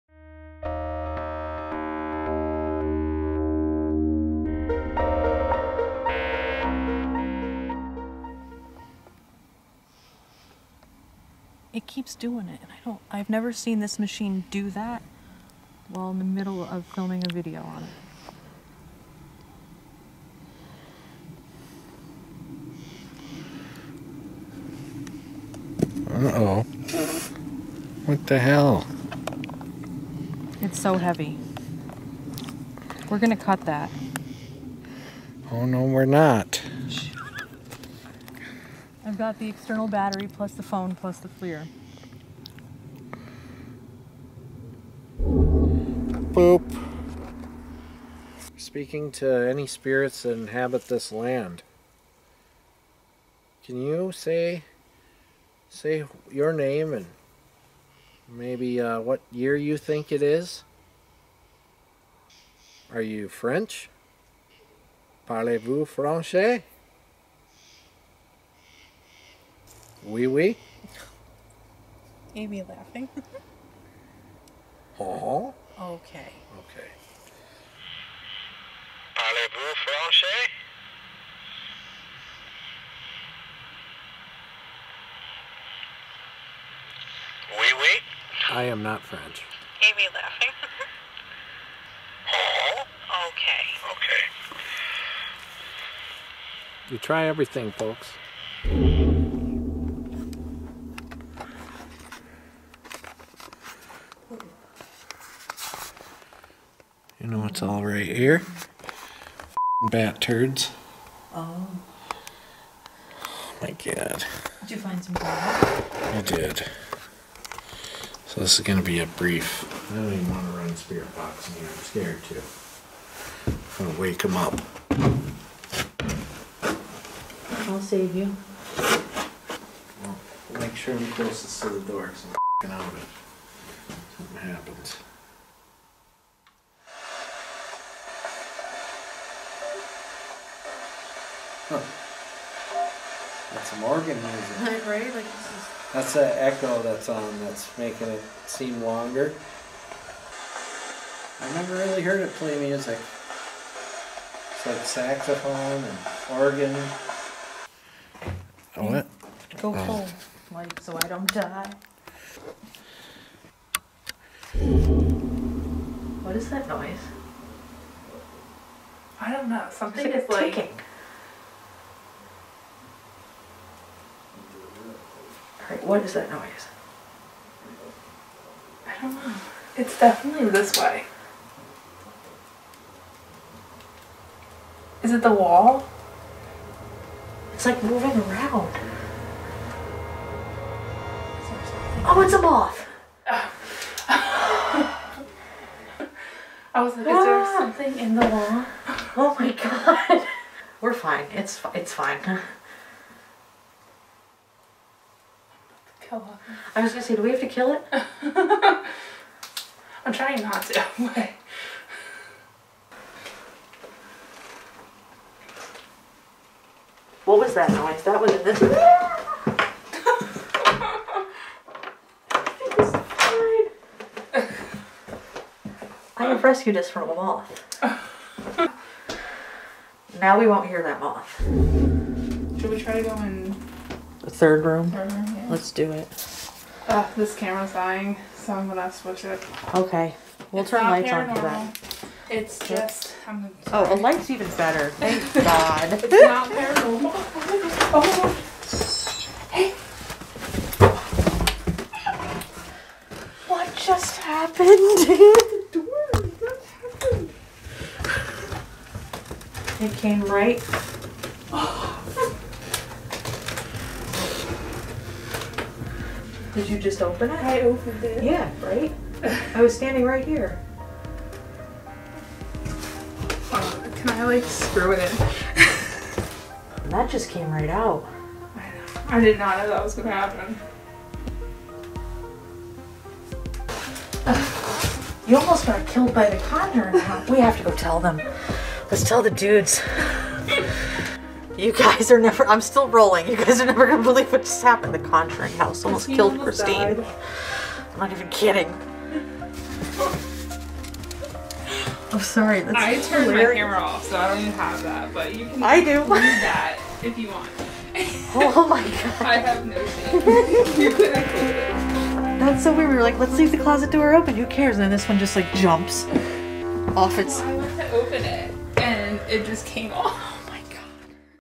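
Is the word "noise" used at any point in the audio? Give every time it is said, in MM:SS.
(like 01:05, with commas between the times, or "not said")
02:46, 02:56, 03:37.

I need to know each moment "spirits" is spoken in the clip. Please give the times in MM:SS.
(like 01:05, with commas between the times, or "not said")
00:49, 02:00.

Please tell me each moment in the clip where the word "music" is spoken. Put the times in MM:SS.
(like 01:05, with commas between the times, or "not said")
02:24, 02:32.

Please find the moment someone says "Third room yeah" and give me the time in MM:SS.
03:54.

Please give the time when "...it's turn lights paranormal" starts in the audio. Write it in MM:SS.
04:00.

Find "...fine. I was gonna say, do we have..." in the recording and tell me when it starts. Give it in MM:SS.
03:21.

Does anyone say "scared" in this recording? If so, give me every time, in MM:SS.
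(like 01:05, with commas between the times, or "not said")
02:01.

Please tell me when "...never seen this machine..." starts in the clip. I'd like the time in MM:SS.
00:13.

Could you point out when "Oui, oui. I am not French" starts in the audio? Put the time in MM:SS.
01:27.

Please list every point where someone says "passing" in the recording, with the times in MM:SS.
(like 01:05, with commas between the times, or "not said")
not said.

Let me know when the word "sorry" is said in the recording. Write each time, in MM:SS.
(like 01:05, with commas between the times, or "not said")
04:03, 05:02.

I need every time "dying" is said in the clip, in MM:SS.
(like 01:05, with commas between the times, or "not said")
03:57.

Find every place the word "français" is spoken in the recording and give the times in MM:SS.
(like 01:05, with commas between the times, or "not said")
01:05, 01:19.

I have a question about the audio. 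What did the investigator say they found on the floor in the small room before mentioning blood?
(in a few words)
bat turds.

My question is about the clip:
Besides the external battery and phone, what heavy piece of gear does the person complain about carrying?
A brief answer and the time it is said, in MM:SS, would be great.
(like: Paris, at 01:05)
FLIR, at 00:41.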